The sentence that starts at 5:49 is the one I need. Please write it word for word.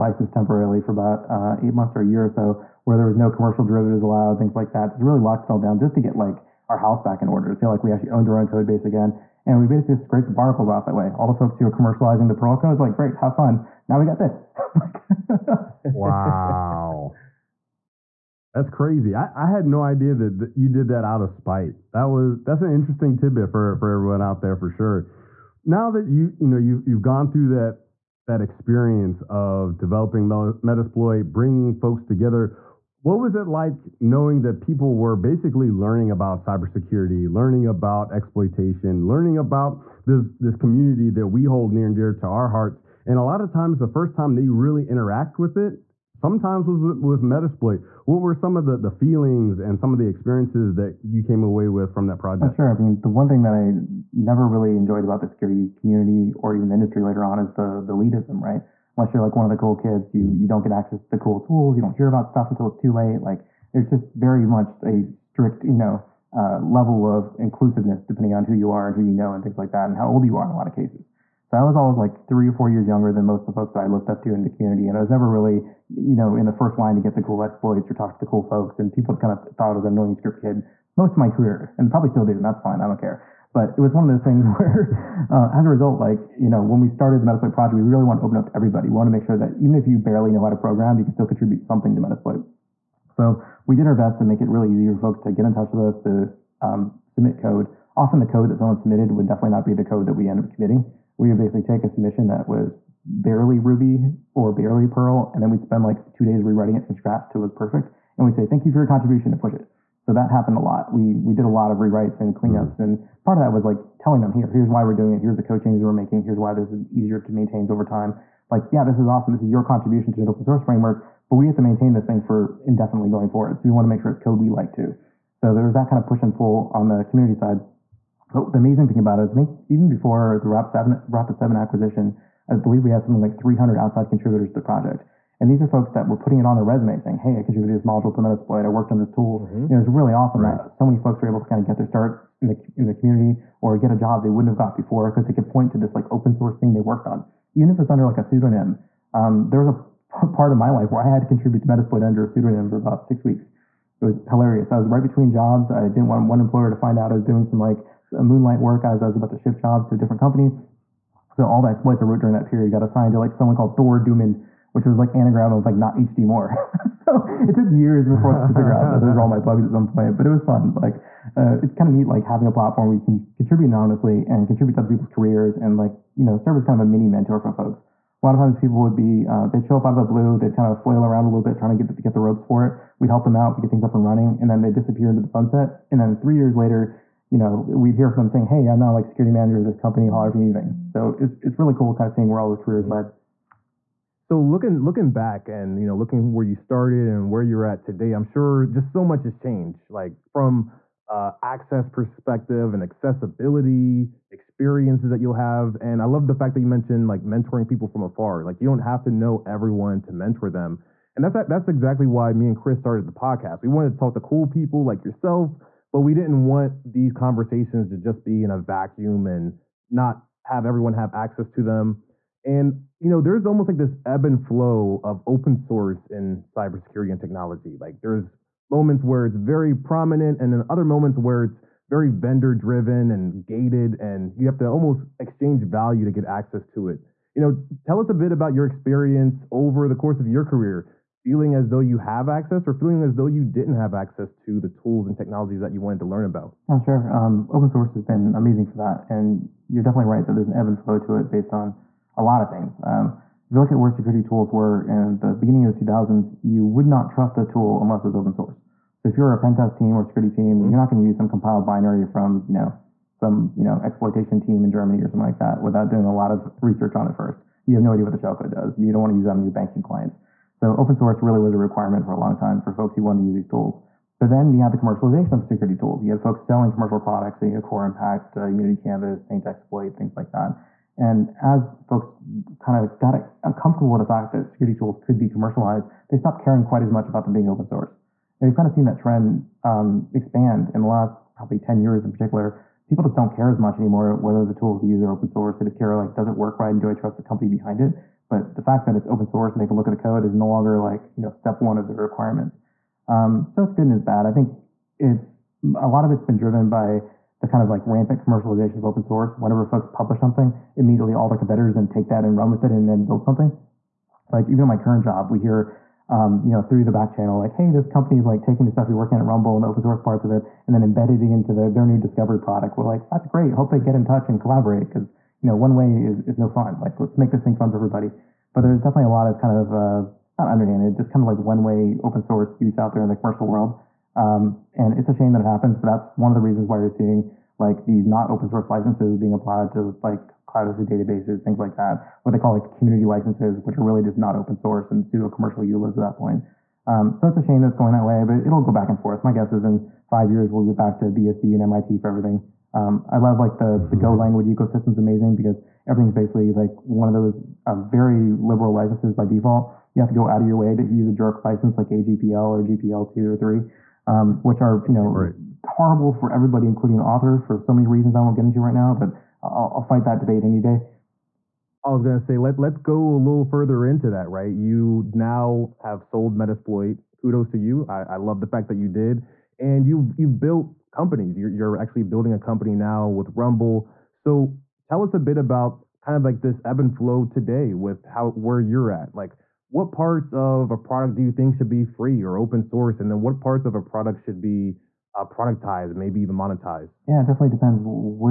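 My guess is in five years we'll be back to BSD and MIT for everything.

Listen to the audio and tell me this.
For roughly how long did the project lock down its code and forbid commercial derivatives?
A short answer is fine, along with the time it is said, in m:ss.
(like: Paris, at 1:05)
8 months, at 0:01.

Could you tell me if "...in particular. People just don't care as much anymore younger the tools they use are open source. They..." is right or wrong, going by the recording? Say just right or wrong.
wrong.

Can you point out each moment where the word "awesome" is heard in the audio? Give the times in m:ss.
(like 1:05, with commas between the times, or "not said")
1:59, 2:20.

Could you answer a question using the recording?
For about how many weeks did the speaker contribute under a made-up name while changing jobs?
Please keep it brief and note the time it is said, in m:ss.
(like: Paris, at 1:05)
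6 weeks, at 2:33.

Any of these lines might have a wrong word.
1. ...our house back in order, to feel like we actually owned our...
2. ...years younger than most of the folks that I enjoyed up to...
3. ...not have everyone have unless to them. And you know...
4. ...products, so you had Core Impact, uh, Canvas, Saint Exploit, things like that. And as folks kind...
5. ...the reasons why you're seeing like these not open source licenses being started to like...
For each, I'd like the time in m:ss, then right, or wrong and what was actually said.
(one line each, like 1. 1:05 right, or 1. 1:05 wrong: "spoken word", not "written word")
1. 0:06 right
2. 1:12 wrong: "looked", not "enjoyed"
3. 3:39 wrong: "access", not "unless"
4. 4:36 right
5. 5:36 wrong: "applied", not "started".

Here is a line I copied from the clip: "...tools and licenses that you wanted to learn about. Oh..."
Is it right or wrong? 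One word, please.
wrong.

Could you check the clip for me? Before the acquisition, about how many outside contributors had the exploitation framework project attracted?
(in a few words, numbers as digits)
300.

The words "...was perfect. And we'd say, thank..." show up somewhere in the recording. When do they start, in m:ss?
1:47.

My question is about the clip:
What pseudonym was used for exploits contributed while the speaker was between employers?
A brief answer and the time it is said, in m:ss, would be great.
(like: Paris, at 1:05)
Thor Doomen, at 2:43.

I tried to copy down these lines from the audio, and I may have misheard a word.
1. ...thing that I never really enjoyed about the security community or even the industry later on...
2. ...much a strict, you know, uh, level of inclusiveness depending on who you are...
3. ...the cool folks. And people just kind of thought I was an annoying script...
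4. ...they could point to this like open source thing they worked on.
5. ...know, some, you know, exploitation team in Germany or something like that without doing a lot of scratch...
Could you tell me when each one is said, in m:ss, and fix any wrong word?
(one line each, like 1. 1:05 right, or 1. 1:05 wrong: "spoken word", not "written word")
1. 0:53 right
2. 1:04 right
3. 1:18 right
4. 2:25 right
5. 4:22 wrong: "research", not "scratch".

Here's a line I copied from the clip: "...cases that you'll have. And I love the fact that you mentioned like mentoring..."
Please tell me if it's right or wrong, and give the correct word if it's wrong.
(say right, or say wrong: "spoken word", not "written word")
wrong: "experiences", not "cases".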